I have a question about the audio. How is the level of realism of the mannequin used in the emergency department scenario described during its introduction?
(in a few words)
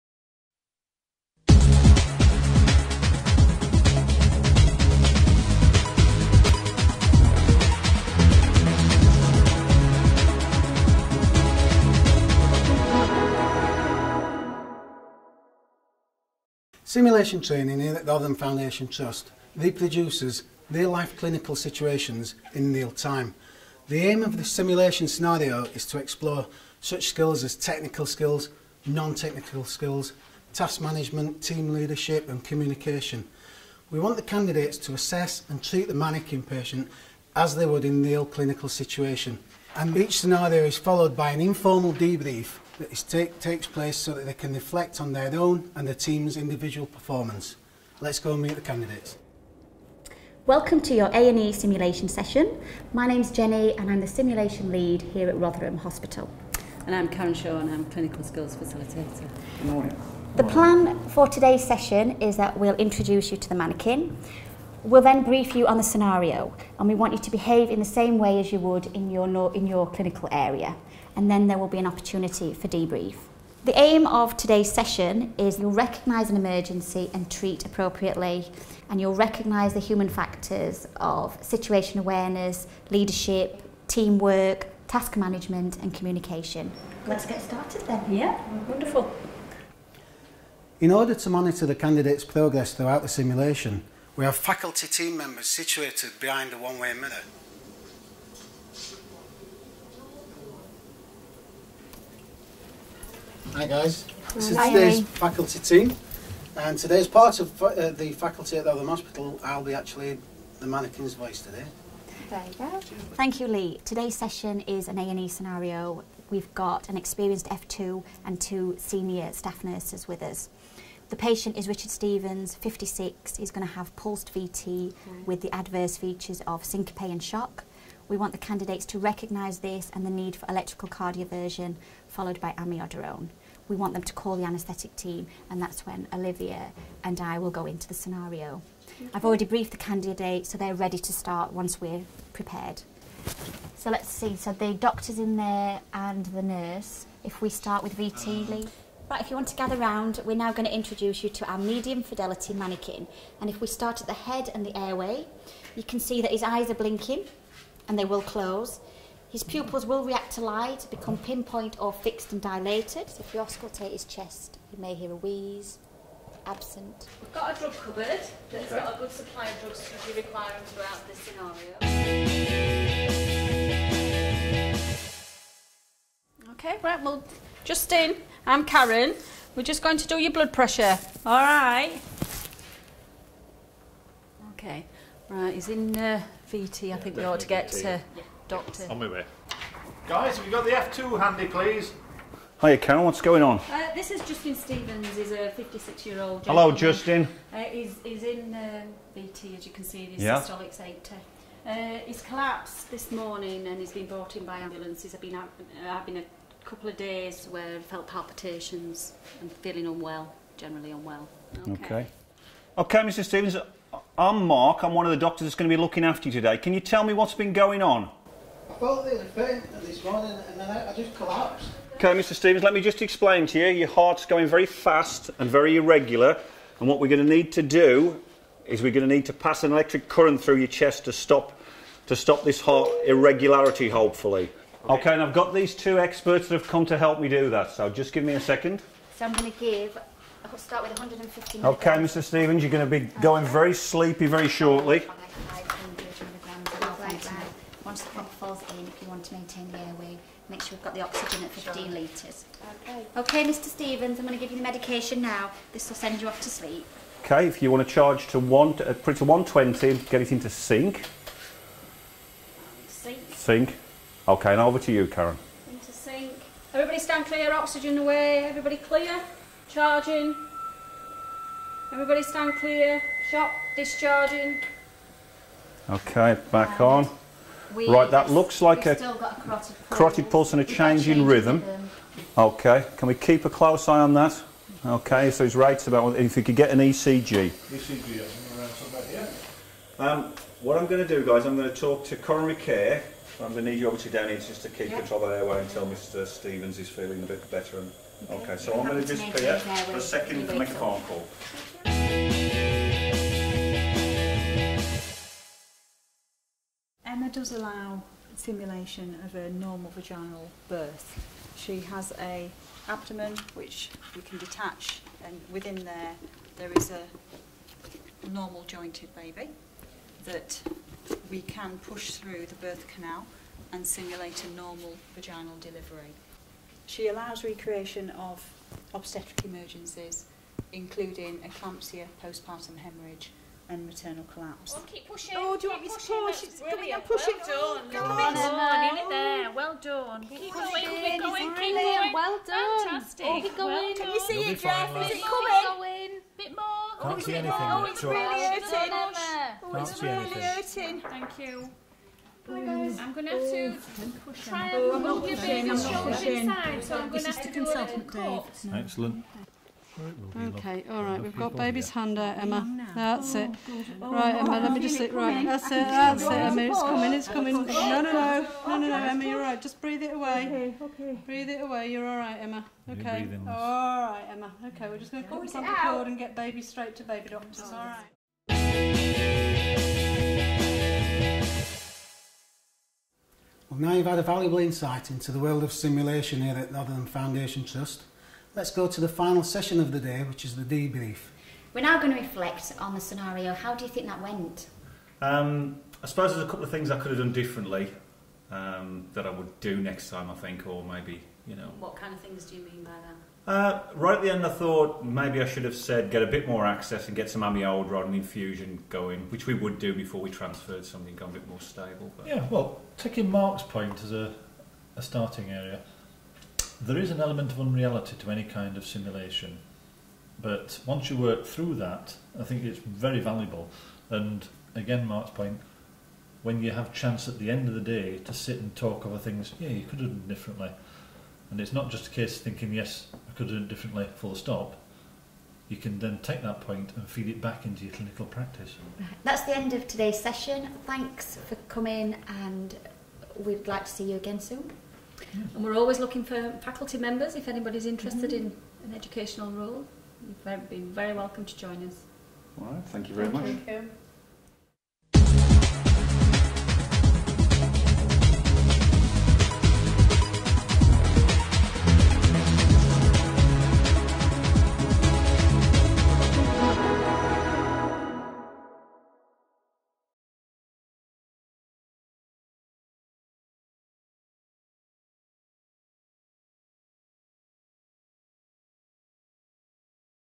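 Medium fidelity.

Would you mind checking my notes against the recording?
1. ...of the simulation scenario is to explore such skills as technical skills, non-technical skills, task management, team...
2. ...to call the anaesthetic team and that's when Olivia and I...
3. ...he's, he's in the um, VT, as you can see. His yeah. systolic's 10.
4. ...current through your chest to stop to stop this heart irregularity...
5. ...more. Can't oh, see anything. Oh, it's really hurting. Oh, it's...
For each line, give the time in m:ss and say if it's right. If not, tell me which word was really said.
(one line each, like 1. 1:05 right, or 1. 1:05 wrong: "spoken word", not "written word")
1. 0:24 right
2. 2:14 right
3. 3:17 wrong: "80", not "10"
4. 3:50 right
5. 5:46 right.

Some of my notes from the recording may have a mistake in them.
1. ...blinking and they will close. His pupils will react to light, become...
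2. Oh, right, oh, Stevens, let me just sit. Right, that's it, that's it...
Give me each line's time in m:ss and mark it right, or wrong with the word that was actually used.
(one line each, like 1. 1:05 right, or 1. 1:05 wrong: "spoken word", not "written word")
1. 2:36 right
2. 6:04 wrong: "Emma", not "Stevens".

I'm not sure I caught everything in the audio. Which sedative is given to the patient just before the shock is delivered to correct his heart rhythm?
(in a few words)
Propofol.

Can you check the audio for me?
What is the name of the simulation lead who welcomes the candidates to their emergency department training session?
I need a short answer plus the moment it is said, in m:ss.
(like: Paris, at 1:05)
Jenny, at 0:52.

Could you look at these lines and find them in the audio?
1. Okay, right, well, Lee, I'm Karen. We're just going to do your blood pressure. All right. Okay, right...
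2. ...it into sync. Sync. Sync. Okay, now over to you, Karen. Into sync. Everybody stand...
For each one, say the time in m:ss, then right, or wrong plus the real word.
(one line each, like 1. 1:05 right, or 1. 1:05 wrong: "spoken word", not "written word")
1. 2:56 wrong: "Justin", not "Lee"
2. 4:20 right.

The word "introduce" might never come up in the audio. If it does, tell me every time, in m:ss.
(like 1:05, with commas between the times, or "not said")
1:02, 2:30.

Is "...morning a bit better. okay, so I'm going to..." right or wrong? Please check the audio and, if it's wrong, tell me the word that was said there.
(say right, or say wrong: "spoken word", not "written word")
wrong: "feeling", not "morning".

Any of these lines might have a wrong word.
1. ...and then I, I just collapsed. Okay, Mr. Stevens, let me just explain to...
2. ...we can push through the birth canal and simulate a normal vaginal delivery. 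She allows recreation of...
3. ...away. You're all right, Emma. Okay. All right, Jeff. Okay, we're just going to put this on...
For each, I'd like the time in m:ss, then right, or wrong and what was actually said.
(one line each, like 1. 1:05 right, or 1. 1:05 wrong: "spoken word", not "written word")
1. 3:40 right
2. 5:21 right
3. 6:11 wrong: "Emma", not "Jeff".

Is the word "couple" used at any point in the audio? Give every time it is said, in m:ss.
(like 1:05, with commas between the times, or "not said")
3:26, 6:36.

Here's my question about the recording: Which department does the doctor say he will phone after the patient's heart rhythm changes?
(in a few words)
Coronary care.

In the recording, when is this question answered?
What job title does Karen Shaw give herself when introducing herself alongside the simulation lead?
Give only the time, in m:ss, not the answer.
0:57.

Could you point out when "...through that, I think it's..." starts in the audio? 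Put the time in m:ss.
7:01.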